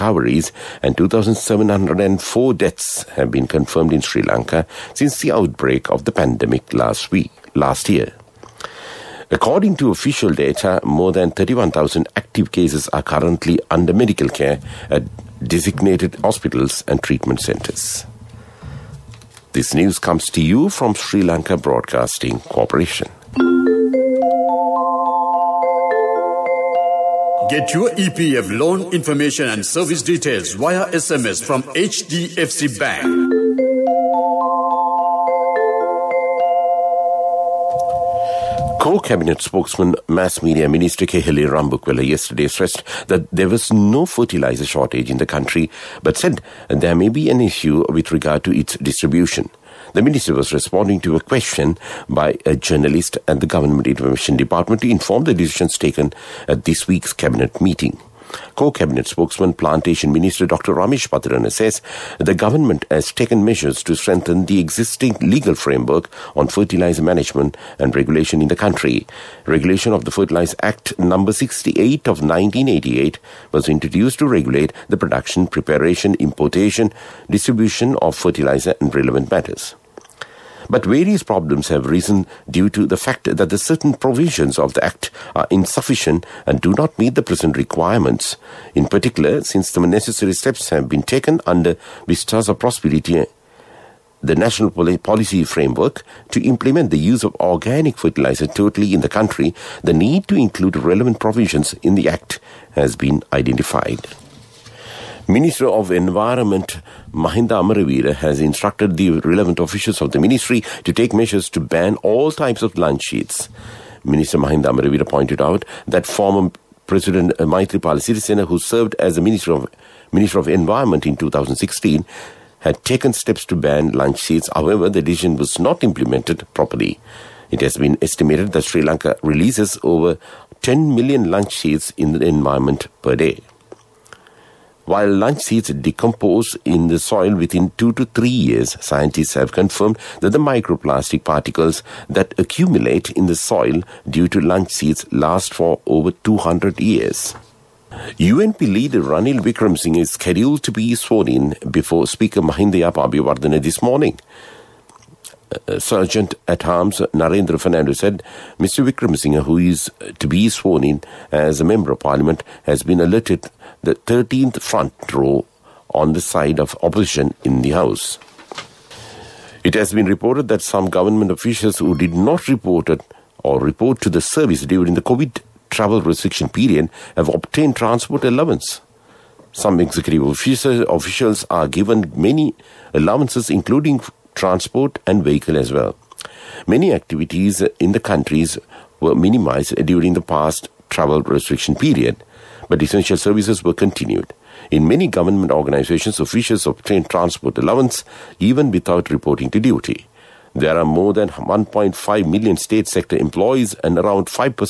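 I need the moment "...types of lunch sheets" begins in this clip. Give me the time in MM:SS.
01:52.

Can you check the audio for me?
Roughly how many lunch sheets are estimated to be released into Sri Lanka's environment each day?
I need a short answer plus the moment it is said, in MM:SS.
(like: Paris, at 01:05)
over 10 million, at 02:09.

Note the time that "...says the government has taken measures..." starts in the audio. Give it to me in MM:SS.
01:01.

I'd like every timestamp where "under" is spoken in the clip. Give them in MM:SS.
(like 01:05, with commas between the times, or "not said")
00:13, 01:31.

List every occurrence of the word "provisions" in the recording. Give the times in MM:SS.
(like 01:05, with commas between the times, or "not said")
01:23, 01:41.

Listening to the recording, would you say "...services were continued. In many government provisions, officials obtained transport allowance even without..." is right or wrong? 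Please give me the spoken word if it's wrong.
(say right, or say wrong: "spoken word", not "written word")
wrong: "organizations", not "provisions".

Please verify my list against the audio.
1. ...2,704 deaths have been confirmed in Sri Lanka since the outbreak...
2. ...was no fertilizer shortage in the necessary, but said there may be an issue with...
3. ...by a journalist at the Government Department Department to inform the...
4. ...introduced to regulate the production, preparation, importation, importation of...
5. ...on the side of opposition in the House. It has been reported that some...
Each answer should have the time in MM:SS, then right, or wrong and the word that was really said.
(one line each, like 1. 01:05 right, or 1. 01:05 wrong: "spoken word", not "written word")
1. 00:00 right
2. 00:43 wrong: "country", not "necessary"
3. 00:52 wrong: "Information", not "Department"
4. 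01:13 wrong: "distribution", not "importation"
5. 02:45 right.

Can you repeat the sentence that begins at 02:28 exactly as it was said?
UNP leader Ranil Singh is scheduled to be sworn in before Speaker Mahinda Yapa this morning.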